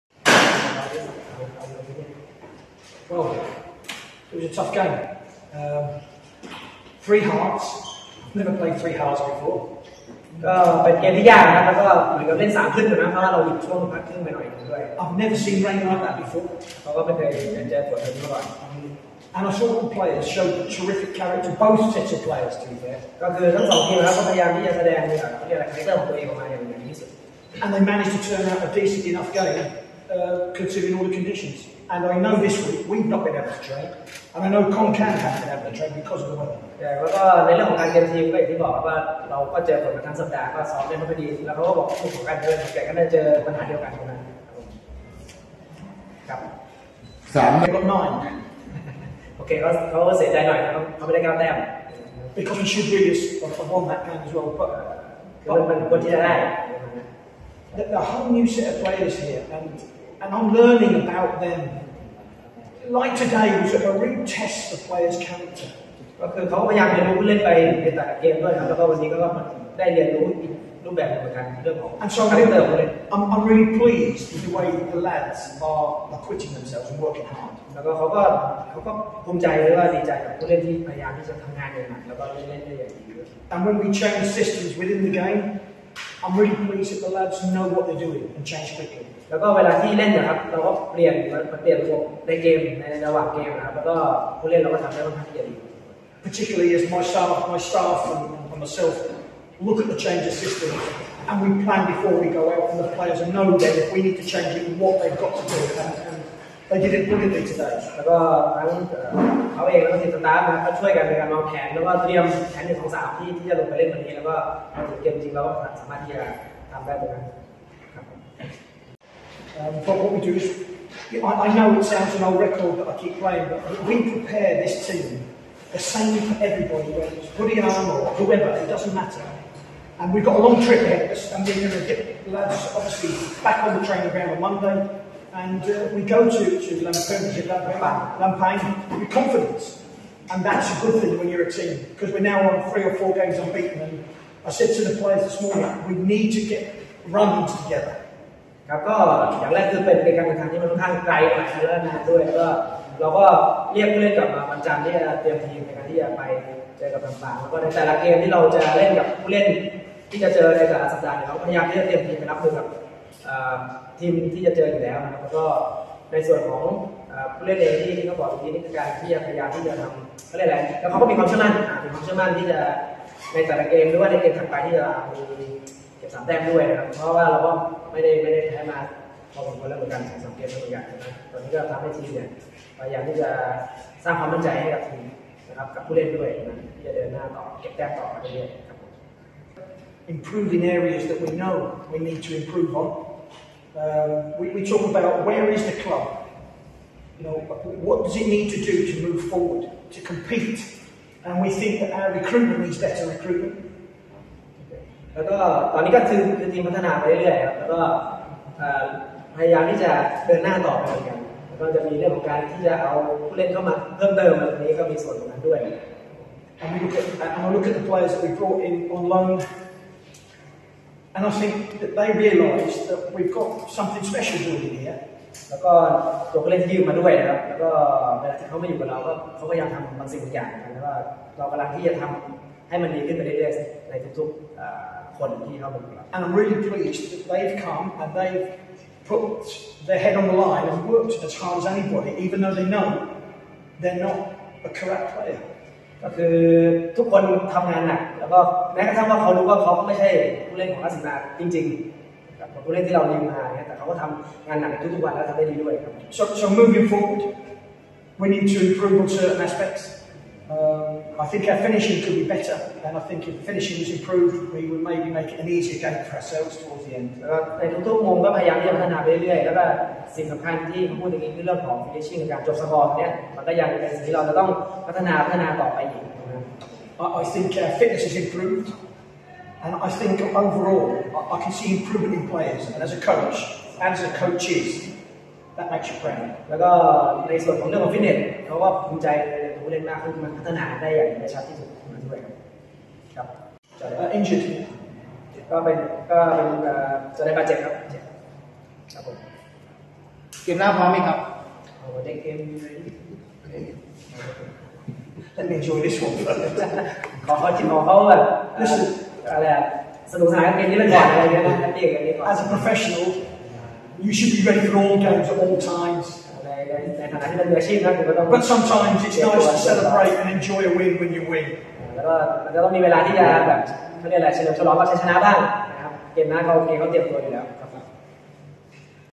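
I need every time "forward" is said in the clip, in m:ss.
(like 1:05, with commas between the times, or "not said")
3:19, 4:16.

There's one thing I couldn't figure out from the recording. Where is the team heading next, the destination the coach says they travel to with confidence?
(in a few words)
Lampang.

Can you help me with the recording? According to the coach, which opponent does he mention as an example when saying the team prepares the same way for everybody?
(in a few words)
Buriram.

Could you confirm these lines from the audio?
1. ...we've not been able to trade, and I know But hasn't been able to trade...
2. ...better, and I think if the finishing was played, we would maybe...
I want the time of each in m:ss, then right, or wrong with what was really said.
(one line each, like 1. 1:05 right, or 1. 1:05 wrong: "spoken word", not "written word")
1. 0:32 wrong: "Concan", not "But"
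2. 4:22 wrong: "improved", not "played".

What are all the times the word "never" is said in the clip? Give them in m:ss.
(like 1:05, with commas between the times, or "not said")
0:08, 0:15.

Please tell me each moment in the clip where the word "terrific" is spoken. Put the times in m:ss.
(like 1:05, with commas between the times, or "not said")
0:20.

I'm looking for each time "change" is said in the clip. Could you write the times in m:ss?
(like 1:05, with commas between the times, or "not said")
1:40, 1:44.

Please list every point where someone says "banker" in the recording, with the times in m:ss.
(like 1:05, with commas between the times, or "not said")
not said.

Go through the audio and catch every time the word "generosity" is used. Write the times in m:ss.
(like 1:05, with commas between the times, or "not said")
not said.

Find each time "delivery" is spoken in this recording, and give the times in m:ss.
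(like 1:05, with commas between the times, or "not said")
not said.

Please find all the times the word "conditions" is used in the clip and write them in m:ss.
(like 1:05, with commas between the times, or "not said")
0:31.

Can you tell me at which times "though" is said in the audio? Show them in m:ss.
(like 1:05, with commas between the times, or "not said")
4:02.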